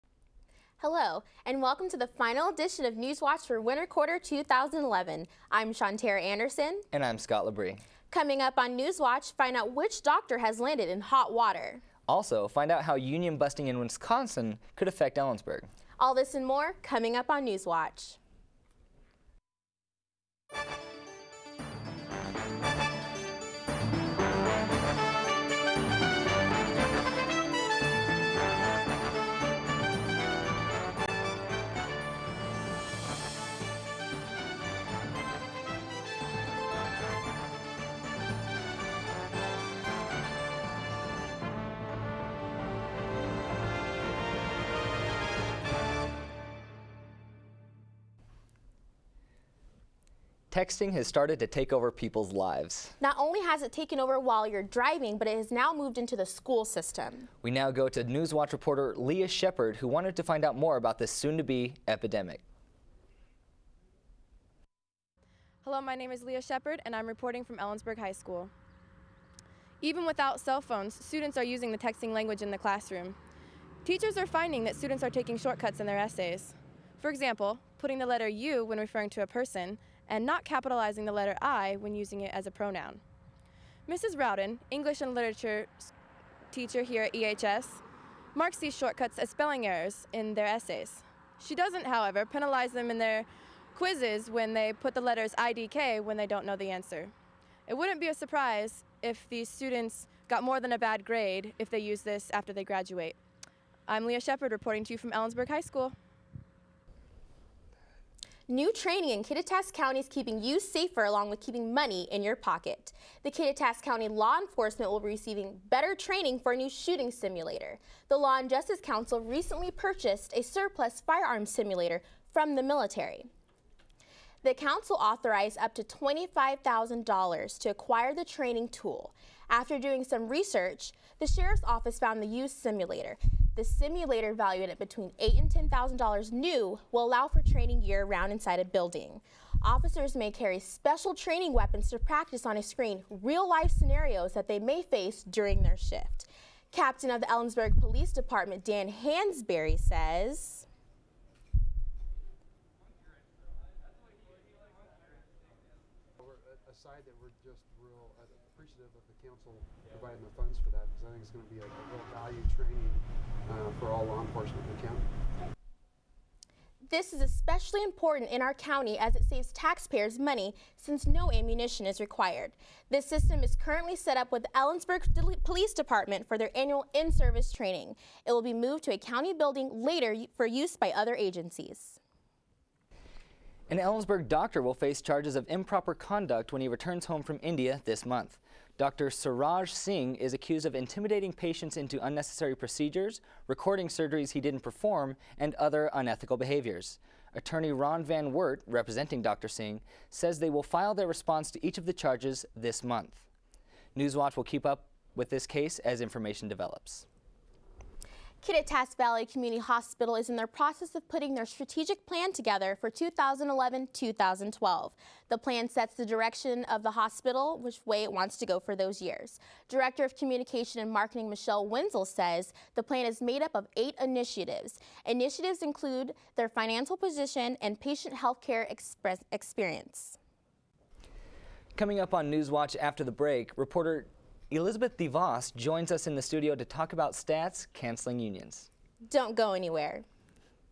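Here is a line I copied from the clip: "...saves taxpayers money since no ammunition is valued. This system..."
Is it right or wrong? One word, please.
wrong.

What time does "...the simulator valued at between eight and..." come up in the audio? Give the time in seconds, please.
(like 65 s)
133 s.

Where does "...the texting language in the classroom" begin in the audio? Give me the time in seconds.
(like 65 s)
71 s.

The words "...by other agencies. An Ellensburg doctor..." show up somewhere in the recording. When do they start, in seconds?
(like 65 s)
180 s.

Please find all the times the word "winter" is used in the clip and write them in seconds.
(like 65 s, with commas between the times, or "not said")
3 s.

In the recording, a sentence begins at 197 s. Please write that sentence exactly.
Attorney Ron Van Wert, representing Dr.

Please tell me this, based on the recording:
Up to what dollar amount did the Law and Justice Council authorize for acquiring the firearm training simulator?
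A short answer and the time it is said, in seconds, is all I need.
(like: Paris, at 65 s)
$25,000, at 125 s.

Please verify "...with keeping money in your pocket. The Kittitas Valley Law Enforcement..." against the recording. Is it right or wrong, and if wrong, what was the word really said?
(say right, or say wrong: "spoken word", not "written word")
wrong: "County", not "Valley".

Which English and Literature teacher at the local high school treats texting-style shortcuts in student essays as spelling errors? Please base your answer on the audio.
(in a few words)
Mrs. Rowden.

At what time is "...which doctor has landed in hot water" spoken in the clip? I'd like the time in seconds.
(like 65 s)
9 s.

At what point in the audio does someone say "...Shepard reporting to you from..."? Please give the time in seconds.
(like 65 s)
104 s.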